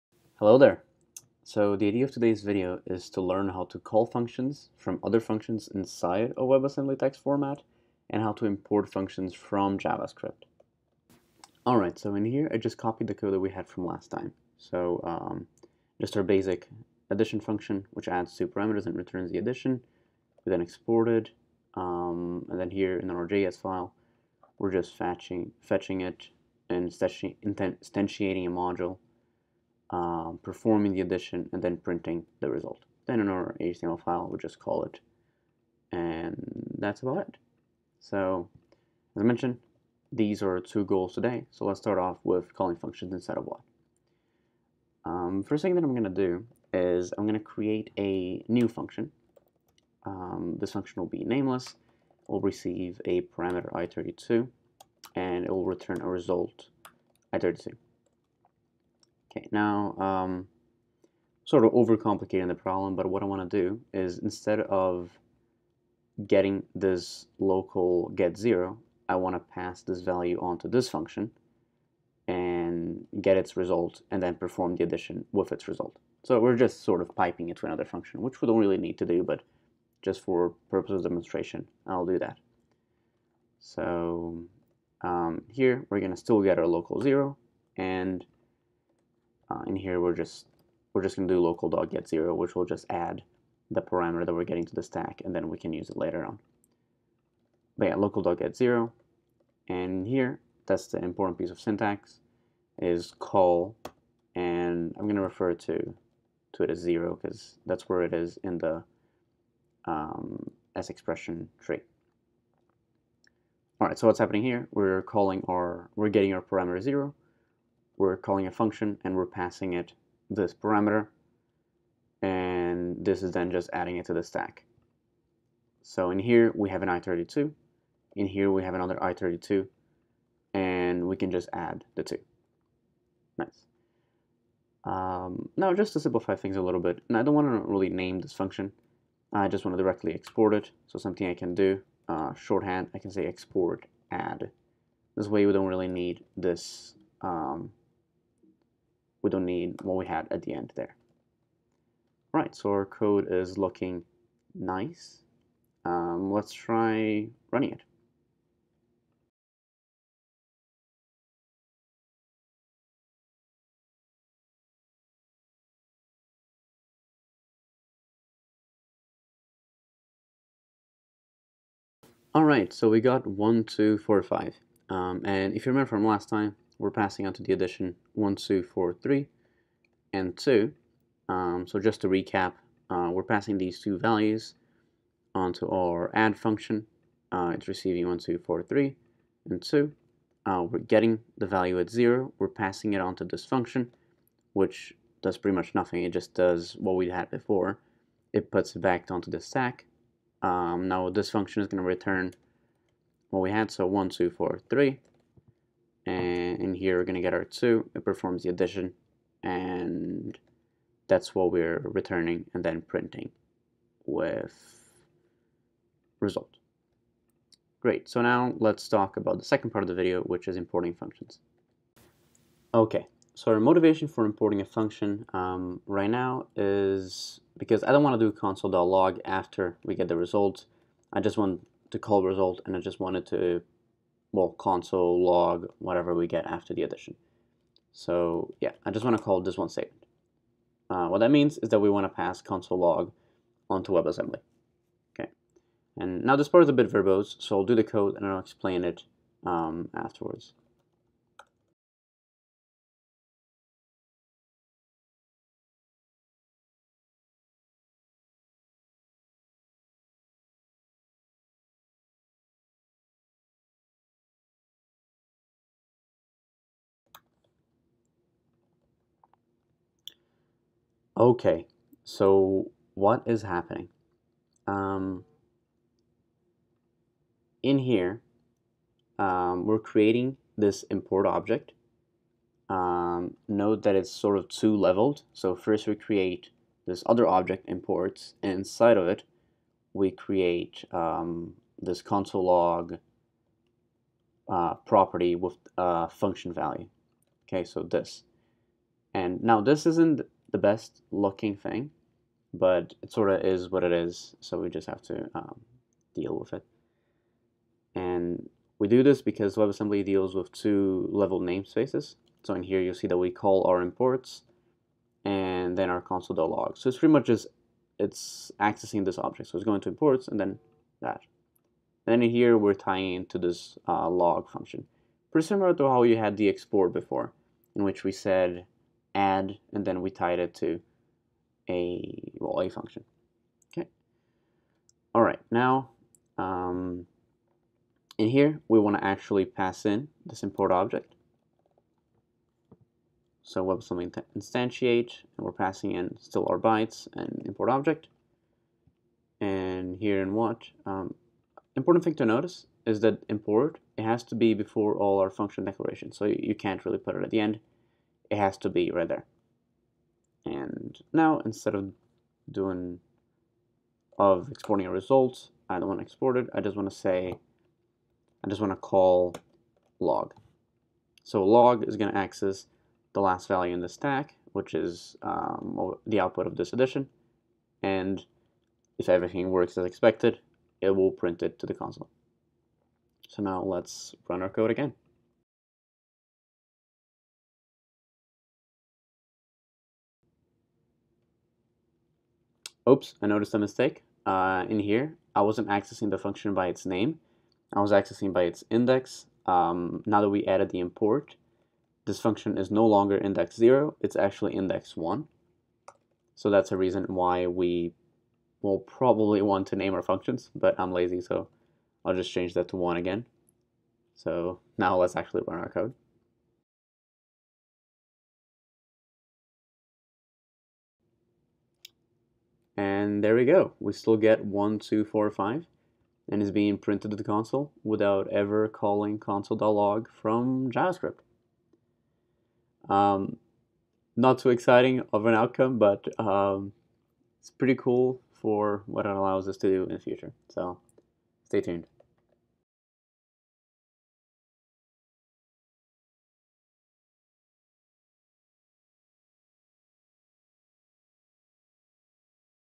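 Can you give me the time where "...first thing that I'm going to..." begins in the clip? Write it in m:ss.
0:45.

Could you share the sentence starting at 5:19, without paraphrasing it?
So it's going to imports and then that.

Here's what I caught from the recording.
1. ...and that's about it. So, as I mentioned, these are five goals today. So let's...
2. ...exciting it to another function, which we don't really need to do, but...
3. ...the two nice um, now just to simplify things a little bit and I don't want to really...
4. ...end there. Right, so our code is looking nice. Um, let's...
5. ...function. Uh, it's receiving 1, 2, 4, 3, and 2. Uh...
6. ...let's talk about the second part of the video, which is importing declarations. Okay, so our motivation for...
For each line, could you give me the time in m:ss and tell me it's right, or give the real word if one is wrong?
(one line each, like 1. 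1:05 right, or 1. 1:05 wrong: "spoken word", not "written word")
1. 0:35 wrong: "two", not "five"
2. 1:17 wrong: "piping", not "exciting"
3. 2:11 right
4. 2:30 right
5. 3:06 right
6. 3:38 wrong: "functions", not "declarations".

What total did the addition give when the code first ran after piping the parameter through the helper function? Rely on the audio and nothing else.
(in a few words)
1245.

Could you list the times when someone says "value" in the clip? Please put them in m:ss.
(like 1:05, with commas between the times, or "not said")
1:10, 3:03, 3:11, 4:56, 6:13.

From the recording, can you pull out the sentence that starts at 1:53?
All right, so what's happening here?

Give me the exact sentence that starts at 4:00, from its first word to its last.
Uh, what that means is that we want to pass console log onto WebAssembly.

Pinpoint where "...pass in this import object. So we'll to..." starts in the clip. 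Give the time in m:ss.
5:39.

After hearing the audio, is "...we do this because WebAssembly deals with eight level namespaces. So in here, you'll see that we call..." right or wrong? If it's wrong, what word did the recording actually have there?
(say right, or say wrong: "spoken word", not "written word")
wrong: "two", not "eight".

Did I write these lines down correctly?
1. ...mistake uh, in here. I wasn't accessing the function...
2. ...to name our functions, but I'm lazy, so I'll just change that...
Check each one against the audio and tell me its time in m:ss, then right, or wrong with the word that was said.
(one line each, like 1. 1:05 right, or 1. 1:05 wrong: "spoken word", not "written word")
1. 6:33 right
2. 6:49 right.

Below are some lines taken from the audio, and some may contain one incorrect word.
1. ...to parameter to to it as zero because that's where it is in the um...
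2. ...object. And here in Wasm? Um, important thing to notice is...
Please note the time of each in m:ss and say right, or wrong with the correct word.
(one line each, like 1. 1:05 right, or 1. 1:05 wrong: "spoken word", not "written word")
1. 1:45 wrong: "refer", not "parameter"
2. 5:47 right.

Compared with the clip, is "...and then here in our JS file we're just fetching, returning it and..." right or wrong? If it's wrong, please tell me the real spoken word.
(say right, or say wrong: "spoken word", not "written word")
wrong: "fetching", not "returning".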